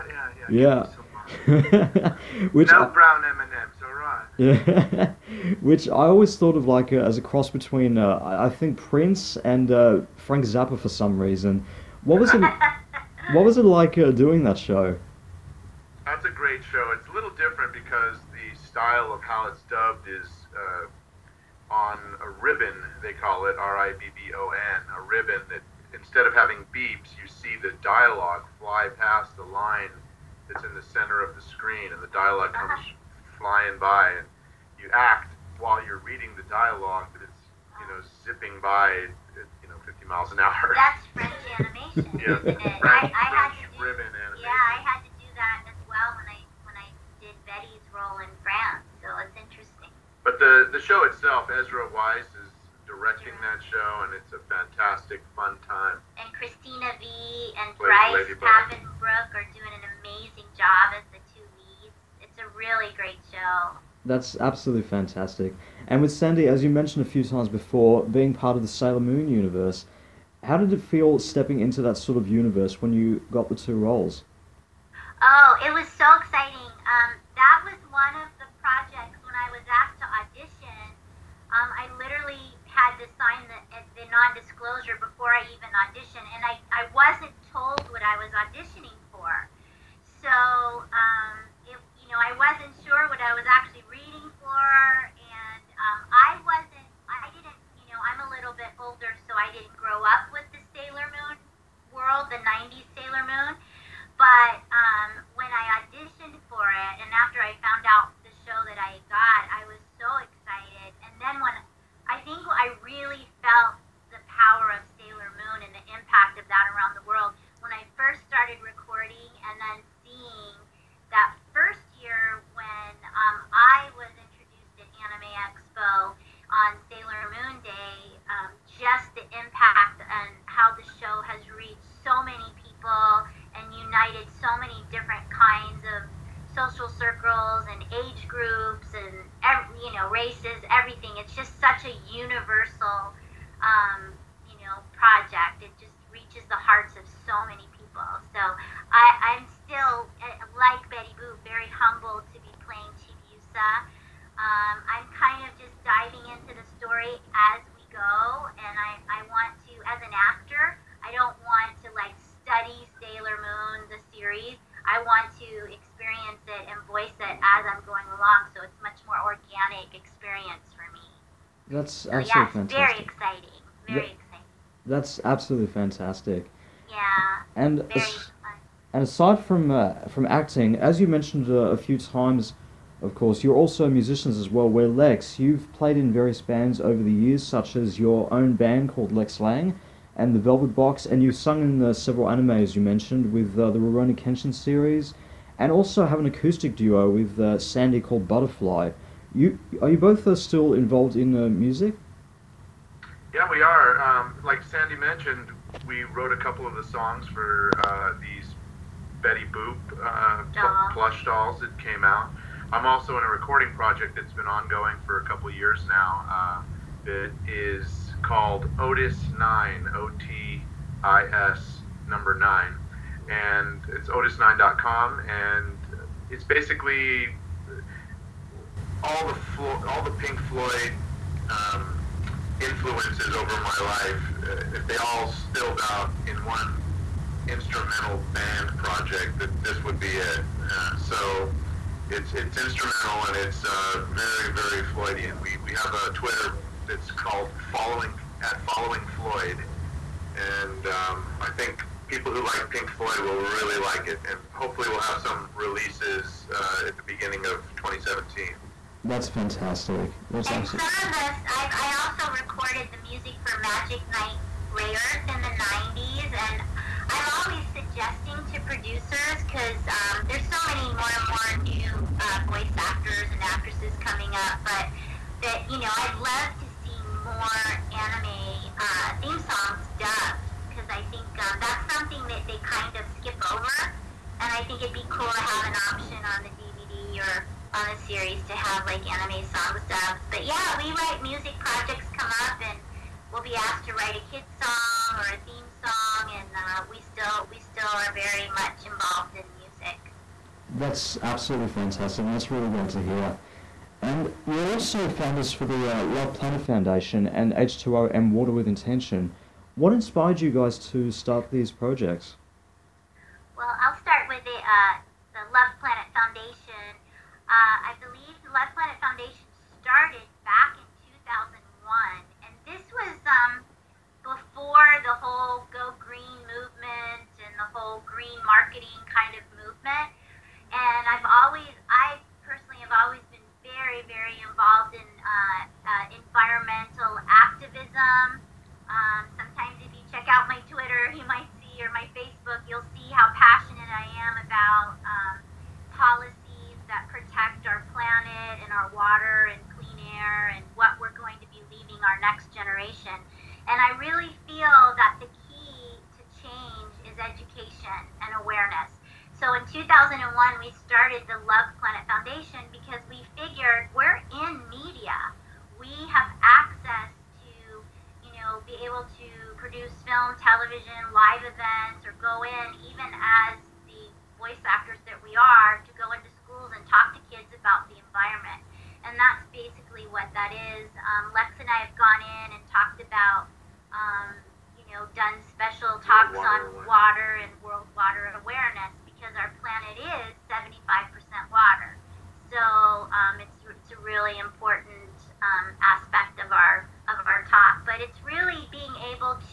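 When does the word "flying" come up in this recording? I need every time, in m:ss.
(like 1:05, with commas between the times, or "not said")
0:33.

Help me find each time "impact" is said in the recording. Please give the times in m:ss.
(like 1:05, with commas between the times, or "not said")
1:55, 2:09.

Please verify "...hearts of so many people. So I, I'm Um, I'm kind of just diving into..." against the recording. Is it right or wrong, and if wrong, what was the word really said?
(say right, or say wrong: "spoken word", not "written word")
right.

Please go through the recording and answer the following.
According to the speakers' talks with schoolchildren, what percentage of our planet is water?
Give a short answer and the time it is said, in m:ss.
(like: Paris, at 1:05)
75%, at 6:30.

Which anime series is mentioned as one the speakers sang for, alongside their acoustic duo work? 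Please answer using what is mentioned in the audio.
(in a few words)
Rurouni Kenshin.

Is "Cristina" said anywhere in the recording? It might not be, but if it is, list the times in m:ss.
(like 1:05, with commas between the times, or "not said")
0:56.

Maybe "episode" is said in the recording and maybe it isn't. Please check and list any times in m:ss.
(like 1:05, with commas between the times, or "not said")
not said.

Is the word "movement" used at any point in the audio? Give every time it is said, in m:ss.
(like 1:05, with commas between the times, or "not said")
5:29.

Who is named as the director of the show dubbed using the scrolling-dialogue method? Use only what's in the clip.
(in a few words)
Ezra Weiss.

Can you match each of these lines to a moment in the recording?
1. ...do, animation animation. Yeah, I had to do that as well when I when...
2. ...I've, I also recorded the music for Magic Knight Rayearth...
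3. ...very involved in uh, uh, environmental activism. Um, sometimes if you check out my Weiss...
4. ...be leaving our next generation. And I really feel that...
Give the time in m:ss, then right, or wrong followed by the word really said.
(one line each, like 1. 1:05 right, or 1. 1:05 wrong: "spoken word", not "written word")
1. 0:43 wrong: "ribbon", not "animation"
2. 4:21 right
3. 5:34 wrong: "Twitter", not "Weiss"
4. 5:51 right.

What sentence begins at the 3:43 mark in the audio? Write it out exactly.
And it's otis9.com, and it's basically all the Flo- all the Pink Floyd um, influences over my life.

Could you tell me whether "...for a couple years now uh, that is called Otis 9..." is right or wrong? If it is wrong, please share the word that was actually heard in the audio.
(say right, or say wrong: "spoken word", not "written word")
right.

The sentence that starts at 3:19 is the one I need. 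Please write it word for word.
You are you both uh, still involved in uh, music?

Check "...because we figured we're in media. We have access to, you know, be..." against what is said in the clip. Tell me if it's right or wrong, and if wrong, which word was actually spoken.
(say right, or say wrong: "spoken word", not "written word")
right.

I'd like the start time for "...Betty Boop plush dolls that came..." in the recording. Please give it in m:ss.
3:29.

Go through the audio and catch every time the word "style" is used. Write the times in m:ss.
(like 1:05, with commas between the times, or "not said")
0:18.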